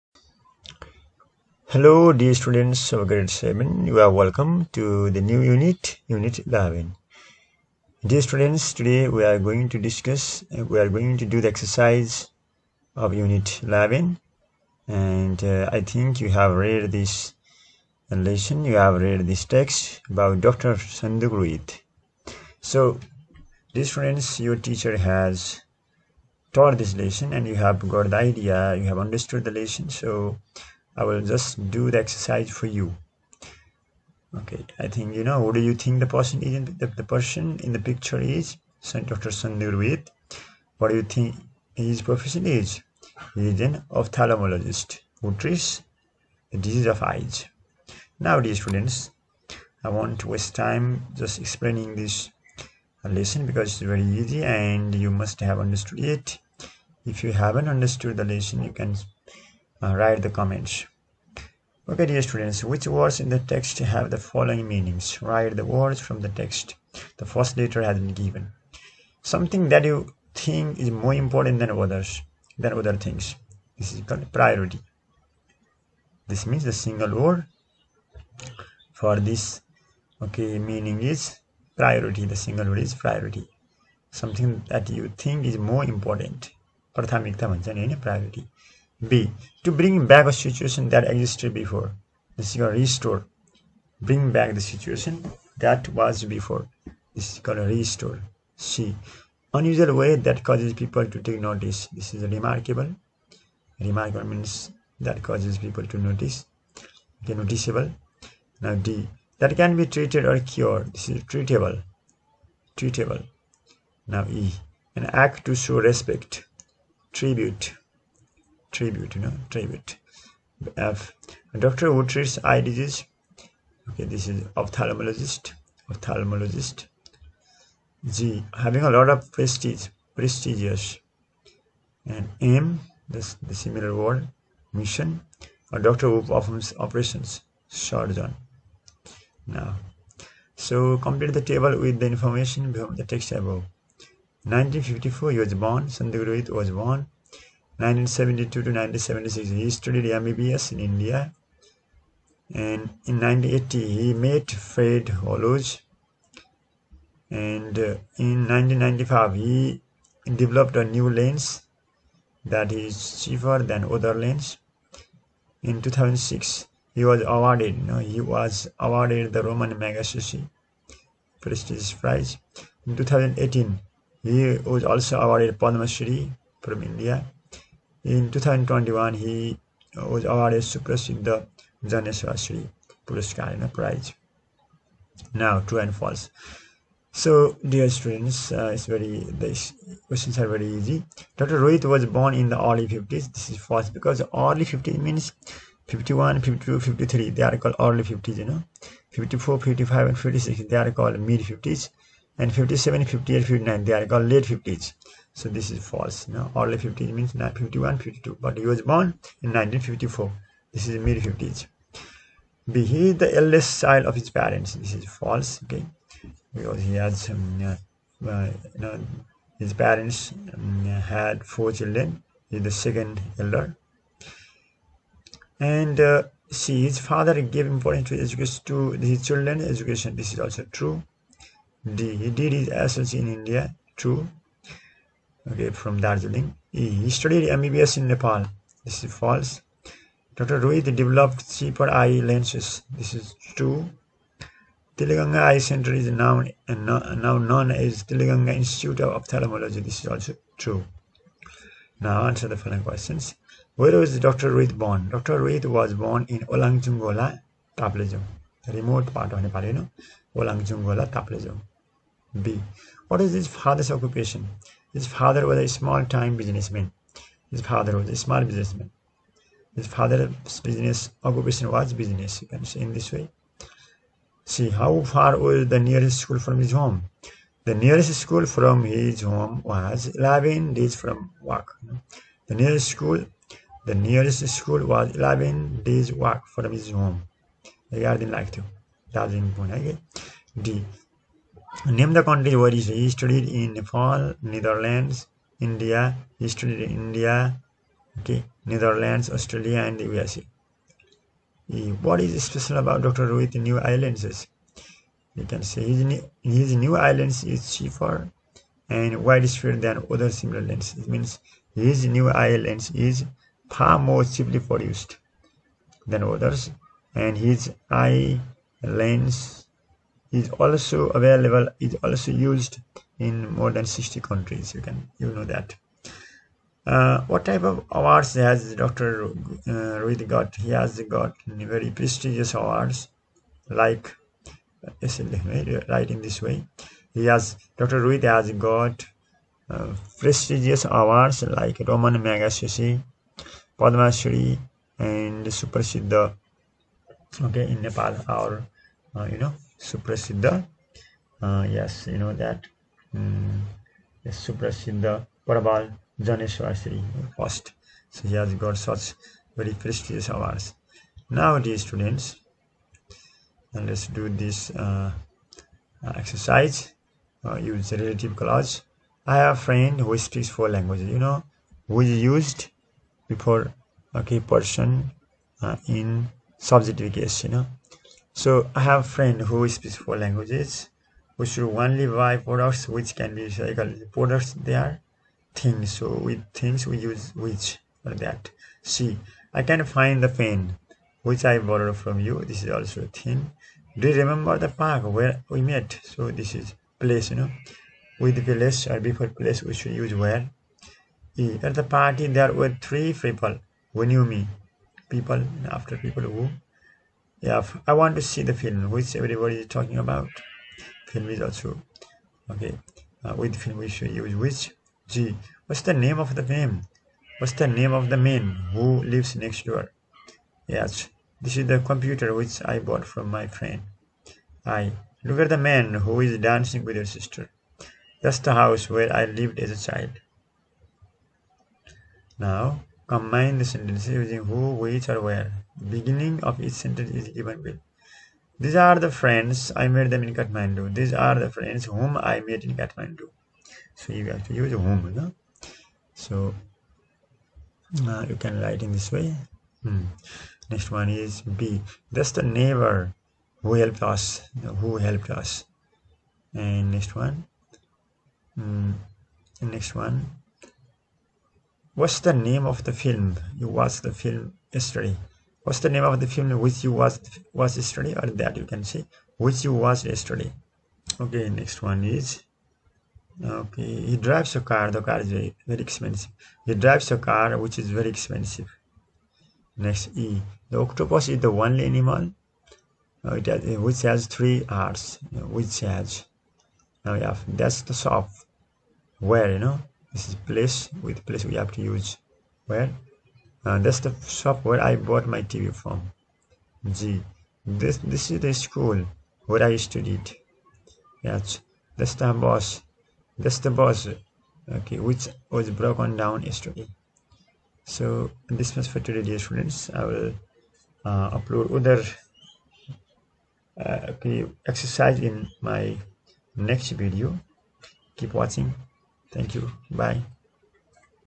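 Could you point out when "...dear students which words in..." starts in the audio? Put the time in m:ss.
1:02.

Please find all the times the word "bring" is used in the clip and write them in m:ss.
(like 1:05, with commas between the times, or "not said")
1:29, 1:33.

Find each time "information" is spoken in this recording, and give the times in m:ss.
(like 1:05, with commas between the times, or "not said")
2:22.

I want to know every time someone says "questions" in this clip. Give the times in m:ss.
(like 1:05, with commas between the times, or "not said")
3:10, 4:12.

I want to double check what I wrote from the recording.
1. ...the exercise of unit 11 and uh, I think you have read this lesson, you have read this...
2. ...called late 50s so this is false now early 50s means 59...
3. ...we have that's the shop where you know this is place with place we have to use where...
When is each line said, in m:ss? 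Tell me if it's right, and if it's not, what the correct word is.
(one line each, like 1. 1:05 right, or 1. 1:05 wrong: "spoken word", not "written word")
1. 0:11 right
2. 3:24 wrong: "51", not "59"
3. 8:07 right.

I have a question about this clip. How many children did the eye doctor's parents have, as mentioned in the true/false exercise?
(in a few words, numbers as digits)
4.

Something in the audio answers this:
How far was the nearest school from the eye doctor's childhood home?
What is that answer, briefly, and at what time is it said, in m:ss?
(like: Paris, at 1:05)
11 days walk, at 4:45.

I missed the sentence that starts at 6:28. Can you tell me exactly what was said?
See, I can find the pen which I borrowed from you.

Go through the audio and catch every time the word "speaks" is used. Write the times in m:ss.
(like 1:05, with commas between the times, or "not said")
6:10, 6:19.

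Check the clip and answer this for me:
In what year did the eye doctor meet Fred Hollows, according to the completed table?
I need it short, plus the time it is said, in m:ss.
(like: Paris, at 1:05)
1980, at 2:33.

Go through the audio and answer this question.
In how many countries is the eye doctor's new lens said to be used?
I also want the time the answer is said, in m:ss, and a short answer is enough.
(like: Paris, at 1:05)
more than 60, at 5:23.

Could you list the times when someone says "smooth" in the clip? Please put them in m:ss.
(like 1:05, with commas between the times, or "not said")
not said.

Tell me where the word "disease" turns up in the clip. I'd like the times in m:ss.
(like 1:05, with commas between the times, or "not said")
0:46, 2:02.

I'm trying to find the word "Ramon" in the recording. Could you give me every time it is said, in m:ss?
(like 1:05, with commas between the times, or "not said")
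2:49, 5:41.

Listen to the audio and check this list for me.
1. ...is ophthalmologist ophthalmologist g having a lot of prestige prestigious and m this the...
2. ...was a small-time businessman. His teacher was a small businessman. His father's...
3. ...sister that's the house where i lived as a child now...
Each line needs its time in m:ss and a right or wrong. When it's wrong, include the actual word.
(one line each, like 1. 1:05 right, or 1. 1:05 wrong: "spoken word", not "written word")
1. 2:04 right
2. 4:25 wrong: "father", not "teacher"
3. 7:07 right.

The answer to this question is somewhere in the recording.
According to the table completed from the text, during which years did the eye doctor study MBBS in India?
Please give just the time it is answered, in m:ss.
2:27.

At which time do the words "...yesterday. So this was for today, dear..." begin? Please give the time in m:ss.
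8:26.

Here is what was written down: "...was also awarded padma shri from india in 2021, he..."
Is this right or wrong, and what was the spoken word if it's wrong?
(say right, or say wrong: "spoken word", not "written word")
right.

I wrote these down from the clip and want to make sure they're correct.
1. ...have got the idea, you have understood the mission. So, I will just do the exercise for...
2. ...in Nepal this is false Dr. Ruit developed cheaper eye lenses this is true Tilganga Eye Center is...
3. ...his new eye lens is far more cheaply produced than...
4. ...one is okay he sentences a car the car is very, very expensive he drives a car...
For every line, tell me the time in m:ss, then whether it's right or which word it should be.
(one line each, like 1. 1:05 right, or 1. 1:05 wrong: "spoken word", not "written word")
1. 0:27 wrong: "lesson", not "mission"
2. 3:57 right
3. 5:11 right
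4. 7:51 wrong: "drives", not "sentences".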